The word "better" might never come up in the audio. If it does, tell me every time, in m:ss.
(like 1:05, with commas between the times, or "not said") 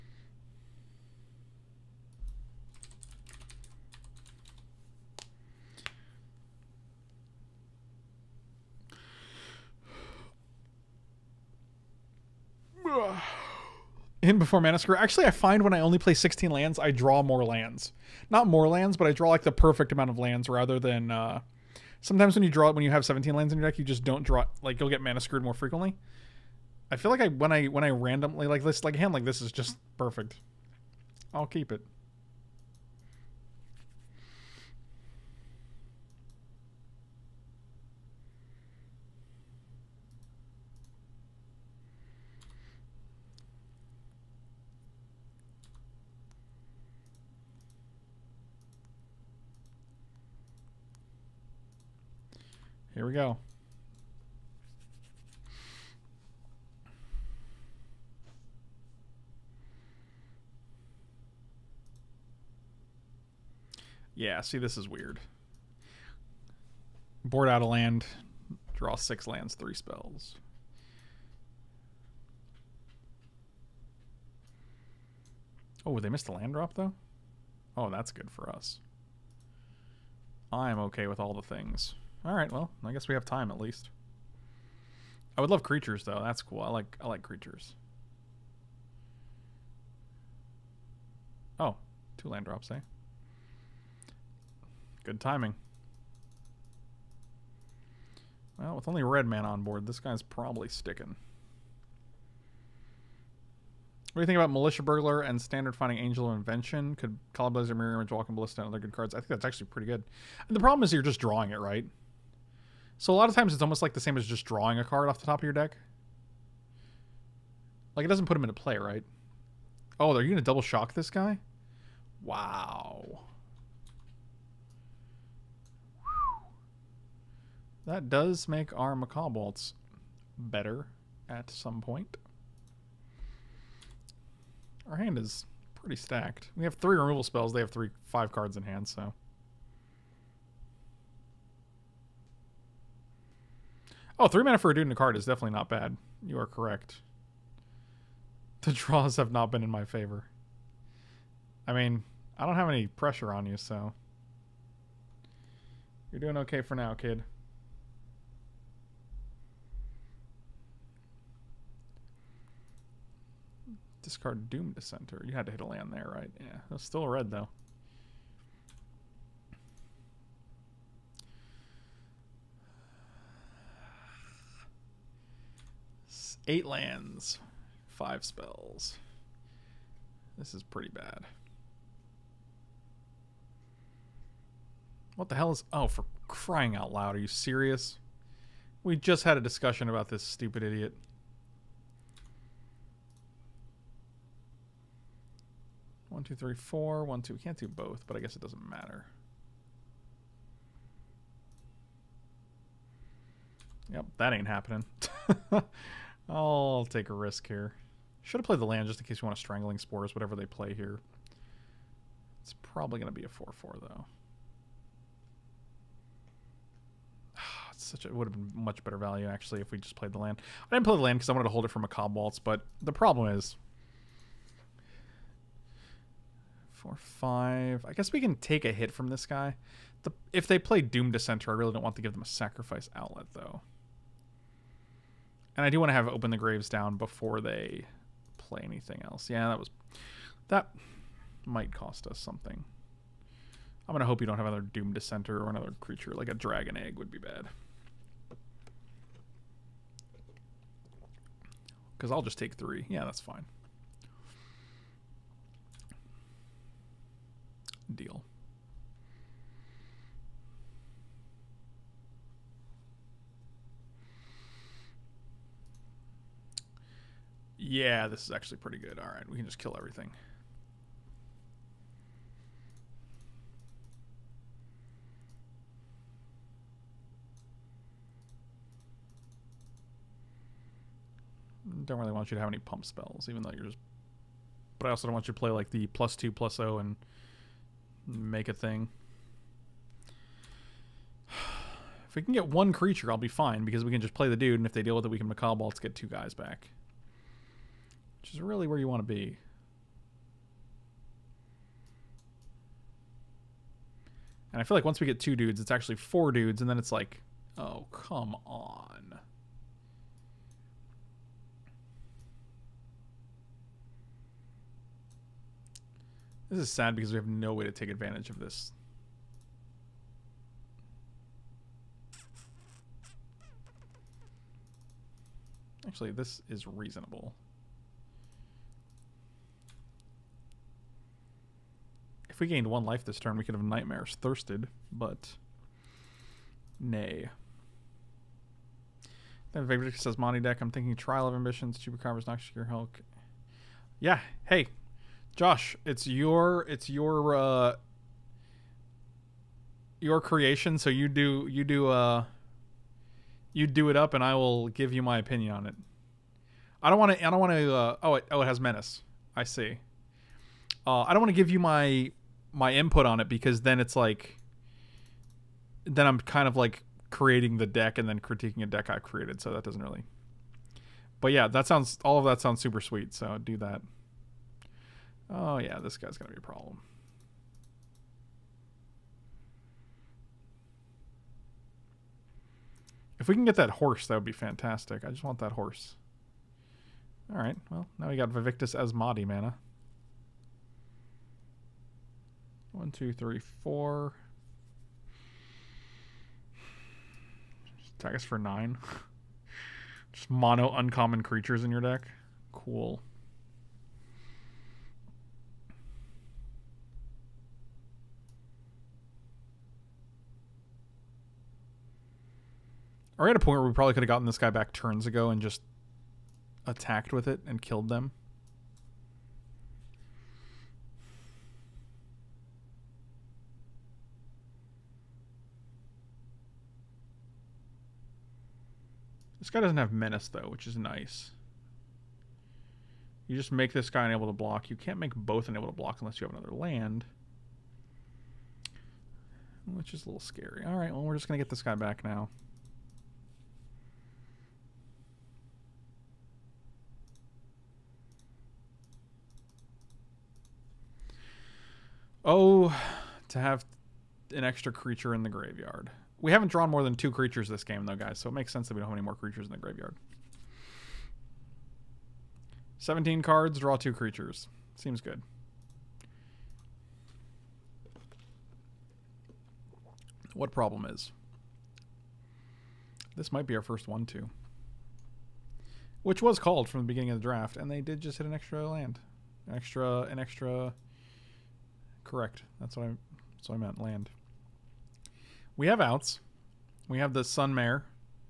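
2:10, 3:38.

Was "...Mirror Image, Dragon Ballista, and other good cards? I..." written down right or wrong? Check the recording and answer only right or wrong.
wrong.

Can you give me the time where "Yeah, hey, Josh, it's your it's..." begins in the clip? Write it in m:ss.
5:44.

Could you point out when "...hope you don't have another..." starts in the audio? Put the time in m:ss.
4:04.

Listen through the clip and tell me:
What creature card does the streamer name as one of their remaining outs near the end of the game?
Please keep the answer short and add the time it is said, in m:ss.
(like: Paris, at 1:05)
Sun Mare, at 8:07.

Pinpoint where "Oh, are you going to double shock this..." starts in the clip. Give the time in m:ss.
1:59.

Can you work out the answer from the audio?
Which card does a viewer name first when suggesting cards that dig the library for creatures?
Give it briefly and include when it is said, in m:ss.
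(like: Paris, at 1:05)
Militia Bugler, at 1:44.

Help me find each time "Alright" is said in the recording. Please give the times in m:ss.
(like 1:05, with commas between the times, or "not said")
1:22, 7:20.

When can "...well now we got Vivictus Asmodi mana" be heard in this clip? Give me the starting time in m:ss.
6:27.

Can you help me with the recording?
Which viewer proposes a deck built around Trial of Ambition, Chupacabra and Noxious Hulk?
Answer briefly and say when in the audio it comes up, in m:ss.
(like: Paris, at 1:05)
Victor, at 5:39.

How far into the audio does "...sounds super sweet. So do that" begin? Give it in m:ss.
6:12.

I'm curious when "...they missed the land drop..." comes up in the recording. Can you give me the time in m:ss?
1:15.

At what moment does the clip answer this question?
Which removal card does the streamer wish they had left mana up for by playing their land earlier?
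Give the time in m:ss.
3:29.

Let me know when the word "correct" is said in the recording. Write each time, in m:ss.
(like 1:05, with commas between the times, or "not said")
2:26, 8:02.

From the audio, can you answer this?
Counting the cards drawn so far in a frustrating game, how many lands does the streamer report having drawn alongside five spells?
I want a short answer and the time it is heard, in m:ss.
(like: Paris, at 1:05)
8, at 2:56.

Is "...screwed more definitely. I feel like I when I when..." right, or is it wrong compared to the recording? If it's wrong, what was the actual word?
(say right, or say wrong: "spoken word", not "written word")
wrong: "frequently", not "definitely".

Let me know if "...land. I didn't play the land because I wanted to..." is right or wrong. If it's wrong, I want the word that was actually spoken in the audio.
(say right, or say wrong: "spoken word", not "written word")
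right.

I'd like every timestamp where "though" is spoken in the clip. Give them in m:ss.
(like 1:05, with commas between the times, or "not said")
1:16, 1:26, 2:47, 3:33, 3:53, 4:43, 7:10, 7:37.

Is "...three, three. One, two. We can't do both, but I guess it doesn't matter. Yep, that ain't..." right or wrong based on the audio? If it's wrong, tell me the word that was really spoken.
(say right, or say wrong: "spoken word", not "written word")
wrong: "four", not "three".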